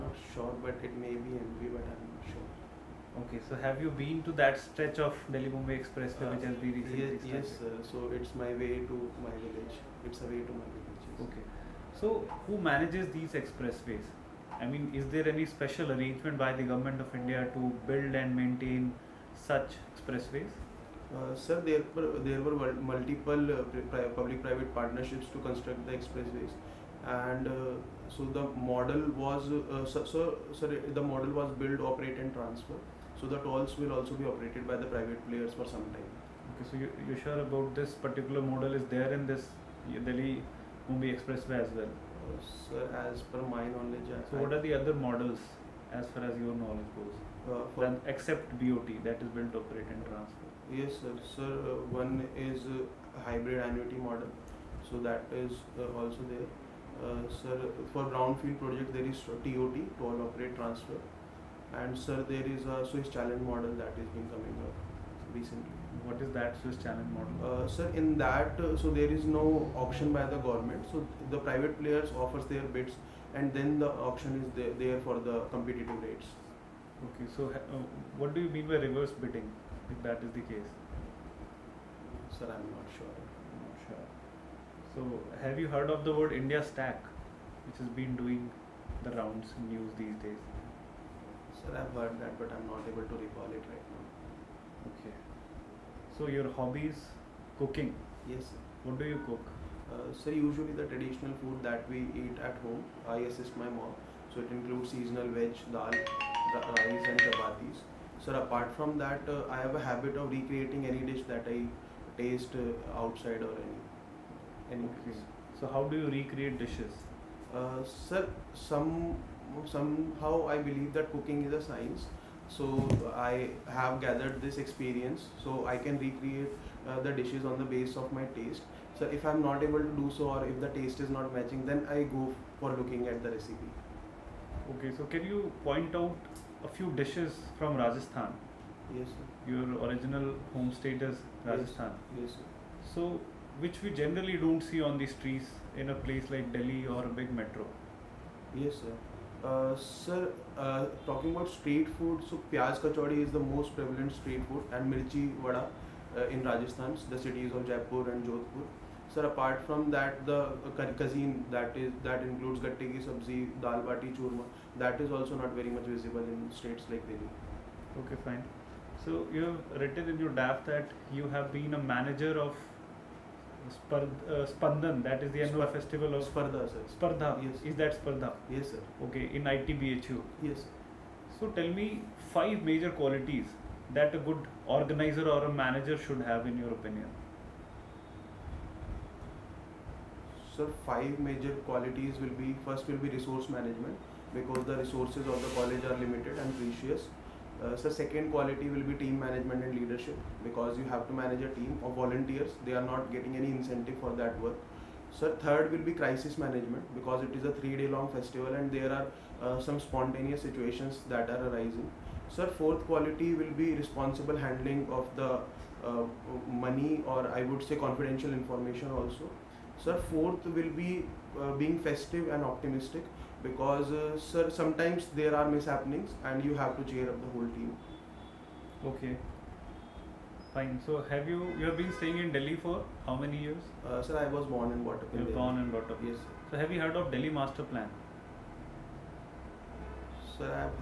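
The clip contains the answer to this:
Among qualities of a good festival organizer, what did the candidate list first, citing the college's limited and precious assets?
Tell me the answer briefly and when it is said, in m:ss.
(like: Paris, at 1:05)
Resource management, at 3:13.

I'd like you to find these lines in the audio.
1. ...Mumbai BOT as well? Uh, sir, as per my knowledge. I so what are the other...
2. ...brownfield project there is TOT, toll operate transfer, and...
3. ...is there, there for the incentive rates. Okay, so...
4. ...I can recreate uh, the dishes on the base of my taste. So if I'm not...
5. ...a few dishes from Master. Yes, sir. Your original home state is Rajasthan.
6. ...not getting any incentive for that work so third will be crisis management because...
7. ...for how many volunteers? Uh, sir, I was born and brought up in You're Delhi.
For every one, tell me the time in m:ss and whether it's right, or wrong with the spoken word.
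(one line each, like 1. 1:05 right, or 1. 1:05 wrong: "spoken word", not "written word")
1. 0:40 wrong: "Expressway", not "BOT"
2. 0:58 right
3. 1:14 wrong: "competitive", not "incentive"
4. 2:05 right
5. 2:16 wrong: "Rajasthan", not "Master"
6. 3:22 right
7. 3:52 wrong: "years", not "volunteers".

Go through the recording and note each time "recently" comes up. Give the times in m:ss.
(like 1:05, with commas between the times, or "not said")
0:06, 1:05.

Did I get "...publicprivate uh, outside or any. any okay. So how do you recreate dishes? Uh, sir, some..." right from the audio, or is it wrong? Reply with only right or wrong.
wrong.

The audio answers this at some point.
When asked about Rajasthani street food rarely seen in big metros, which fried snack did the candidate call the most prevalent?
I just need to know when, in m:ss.
2:32.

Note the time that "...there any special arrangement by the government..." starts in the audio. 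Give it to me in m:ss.
0:15.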